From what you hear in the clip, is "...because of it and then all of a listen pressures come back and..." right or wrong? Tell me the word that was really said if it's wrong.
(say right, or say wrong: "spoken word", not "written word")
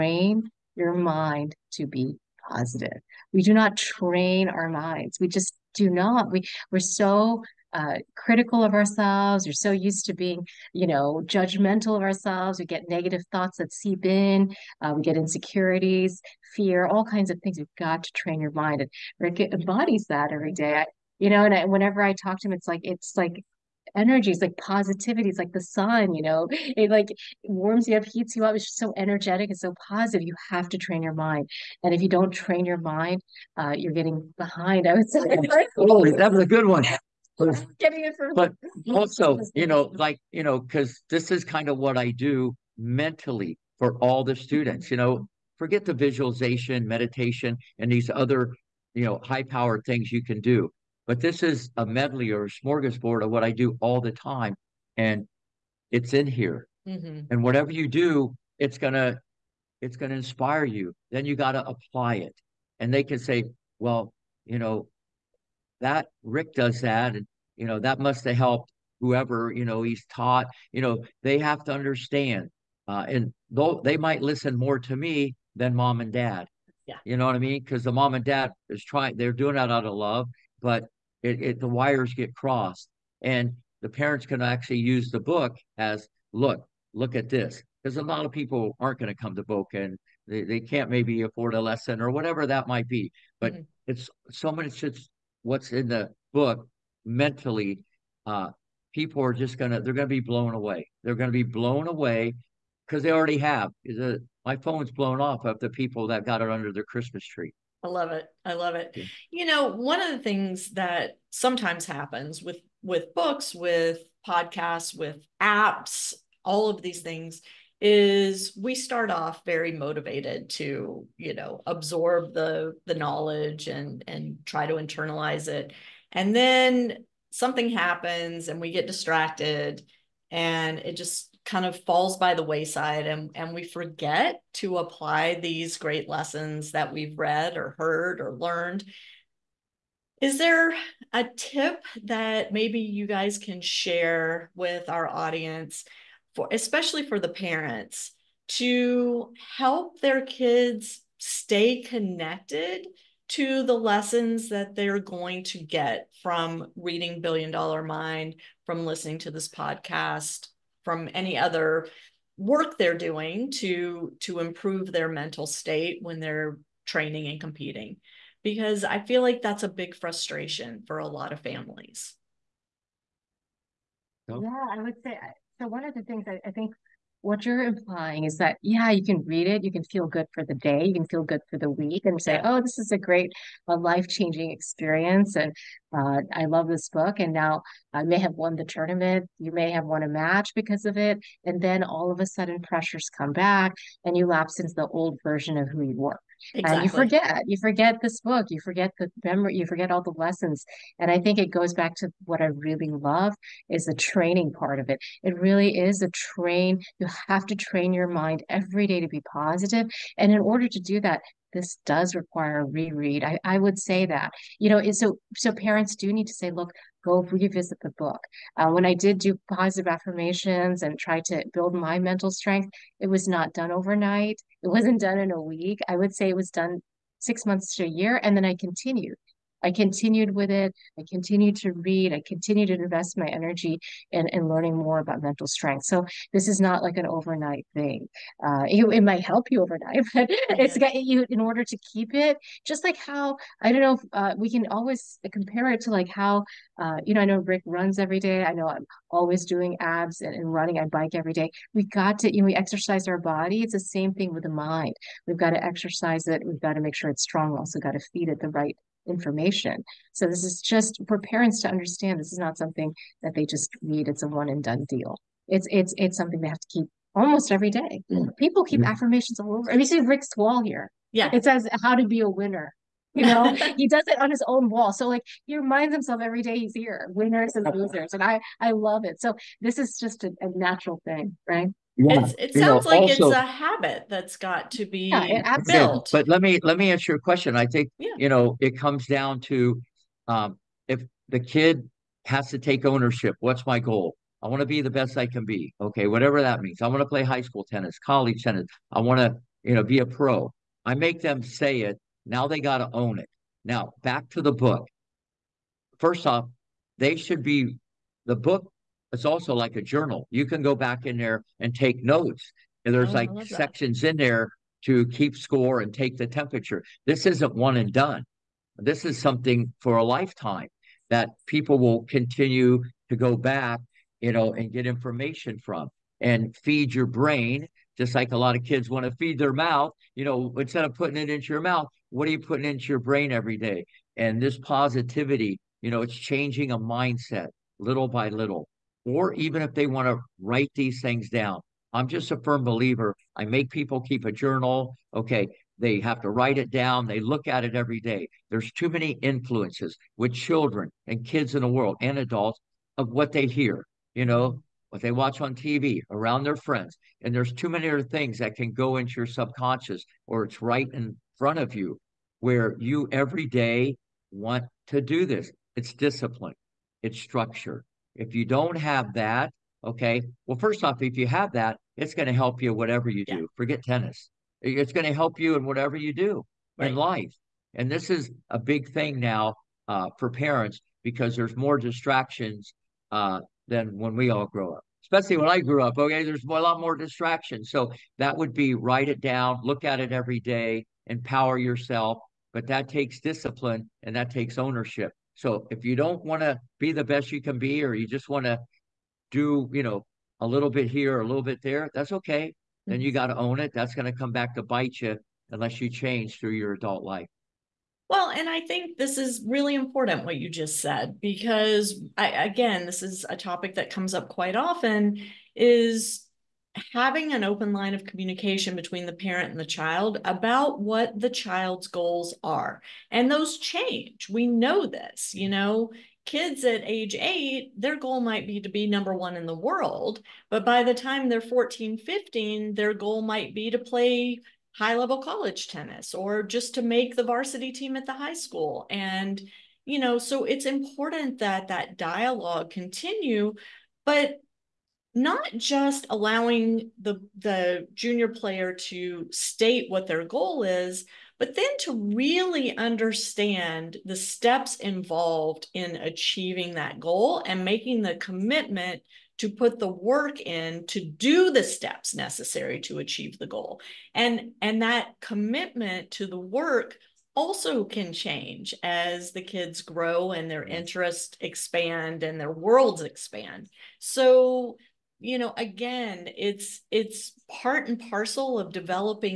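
wrong: "sudden", not "listen".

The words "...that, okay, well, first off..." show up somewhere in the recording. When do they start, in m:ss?
6:09.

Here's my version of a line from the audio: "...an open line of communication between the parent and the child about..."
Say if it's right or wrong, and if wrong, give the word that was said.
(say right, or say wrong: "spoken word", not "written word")
right.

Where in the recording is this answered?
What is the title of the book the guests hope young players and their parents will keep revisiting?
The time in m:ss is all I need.
2:37.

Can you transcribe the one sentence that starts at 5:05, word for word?
First off, they should be the book it's also like a journal.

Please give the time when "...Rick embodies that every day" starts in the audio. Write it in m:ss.
0:19.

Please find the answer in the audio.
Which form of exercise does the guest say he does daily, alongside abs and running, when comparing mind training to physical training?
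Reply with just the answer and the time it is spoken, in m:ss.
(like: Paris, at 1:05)
bike, at 4:10.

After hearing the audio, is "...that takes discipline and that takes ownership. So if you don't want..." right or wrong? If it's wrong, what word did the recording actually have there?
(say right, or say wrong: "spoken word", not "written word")
right.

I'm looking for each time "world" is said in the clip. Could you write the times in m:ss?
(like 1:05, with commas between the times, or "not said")
5:51, 7:09, 7:52.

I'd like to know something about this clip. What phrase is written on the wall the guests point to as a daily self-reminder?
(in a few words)
how to be a winner.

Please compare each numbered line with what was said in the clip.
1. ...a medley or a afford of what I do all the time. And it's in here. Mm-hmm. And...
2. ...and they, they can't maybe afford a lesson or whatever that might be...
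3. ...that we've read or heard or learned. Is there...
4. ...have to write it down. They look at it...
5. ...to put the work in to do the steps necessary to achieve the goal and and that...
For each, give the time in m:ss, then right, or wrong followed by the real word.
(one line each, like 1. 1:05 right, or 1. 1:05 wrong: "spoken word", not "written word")
1. 0:51 wrong: "smorgasbord", not "afford"
2. 1:29 right
3. 2:16 right
4. 5:46 right
5. 7:39 right.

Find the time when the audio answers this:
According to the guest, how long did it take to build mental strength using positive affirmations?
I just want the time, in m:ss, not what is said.
3:47.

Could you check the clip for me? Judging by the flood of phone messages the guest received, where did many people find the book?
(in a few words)
under their Christmas tree.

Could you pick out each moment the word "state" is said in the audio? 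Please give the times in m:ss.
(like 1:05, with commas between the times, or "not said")
2:45, 7:29.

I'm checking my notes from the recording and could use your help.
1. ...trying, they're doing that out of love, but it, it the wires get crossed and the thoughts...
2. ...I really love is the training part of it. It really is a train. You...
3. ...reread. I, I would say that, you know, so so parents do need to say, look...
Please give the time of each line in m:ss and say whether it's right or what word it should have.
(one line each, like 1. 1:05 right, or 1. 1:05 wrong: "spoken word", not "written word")
1. 1:18 wrong: "parents", not "thoughts"
2. 3:22 right
3. 3:32 right.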